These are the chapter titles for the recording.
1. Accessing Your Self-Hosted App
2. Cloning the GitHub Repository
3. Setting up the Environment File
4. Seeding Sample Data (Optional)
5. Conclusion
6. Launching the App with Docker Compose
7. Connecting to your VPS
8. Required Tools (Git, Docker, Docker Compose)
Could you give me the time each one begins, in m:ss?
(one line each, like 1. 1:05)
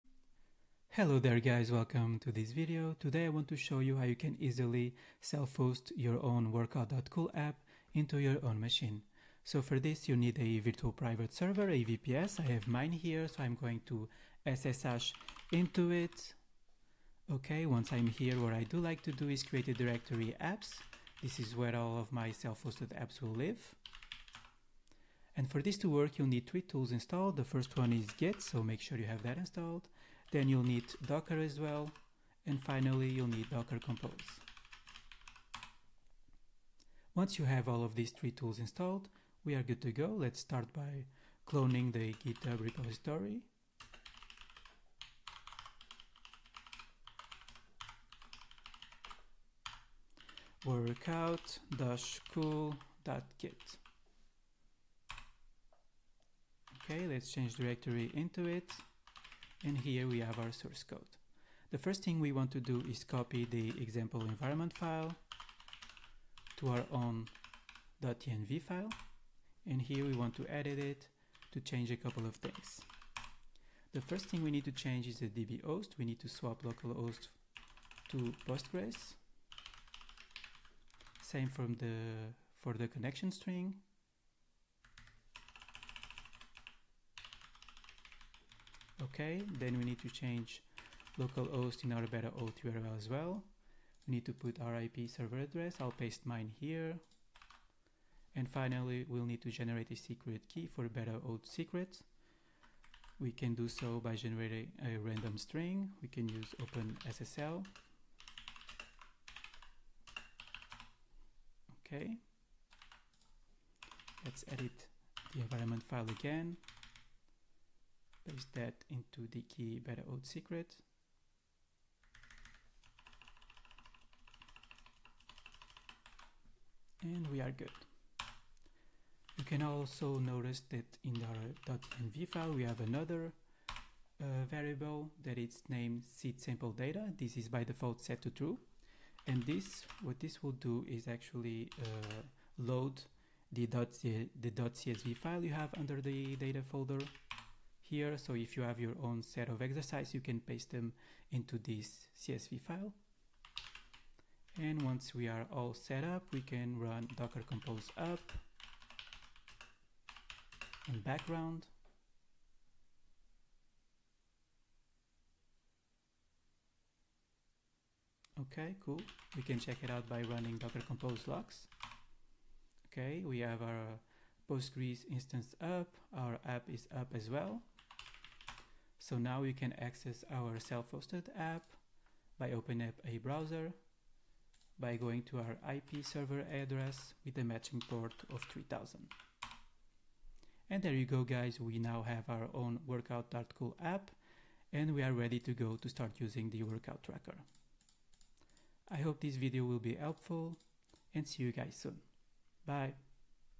1. 2:58
2. 0:40
3. 1:00
4. 2:08
5. 3:10
6. 2:35
7. 0:10
8. 0:25.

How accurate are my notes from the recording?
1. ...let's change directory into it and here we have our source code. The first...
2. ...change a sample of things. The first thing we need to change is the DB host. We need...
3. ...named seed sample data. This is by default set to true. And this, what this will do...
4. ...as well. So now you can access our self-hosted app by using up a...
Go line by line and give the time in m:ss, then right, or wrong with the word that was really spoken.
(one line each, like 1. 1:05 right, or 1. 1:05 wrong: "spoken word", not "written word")
1. 0:57 right
2. 1:11 wrong: "couple", not "sample"
3. 2:15 right
4. 2:57 wrong: "opening", not "using".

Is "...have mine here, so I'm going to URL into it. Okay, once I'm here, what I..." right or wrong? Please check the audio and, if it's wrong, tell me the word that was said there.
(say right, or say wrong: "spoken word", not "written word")
wrong: "SSH", not "URL".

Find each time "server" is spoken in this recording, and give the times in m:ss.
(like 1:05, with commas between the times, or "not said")
0:11, 1:35, 3:06.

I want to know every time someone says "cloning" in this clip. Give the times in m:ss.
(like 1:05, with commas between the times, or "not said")
0:41.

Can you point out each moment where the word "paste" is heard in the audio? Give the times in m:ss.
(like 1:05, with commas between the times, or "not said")
1:35, 1:58, 2:30.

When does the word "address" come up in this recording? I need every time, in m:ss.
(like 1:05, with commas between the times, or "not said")
1:35, 3:06.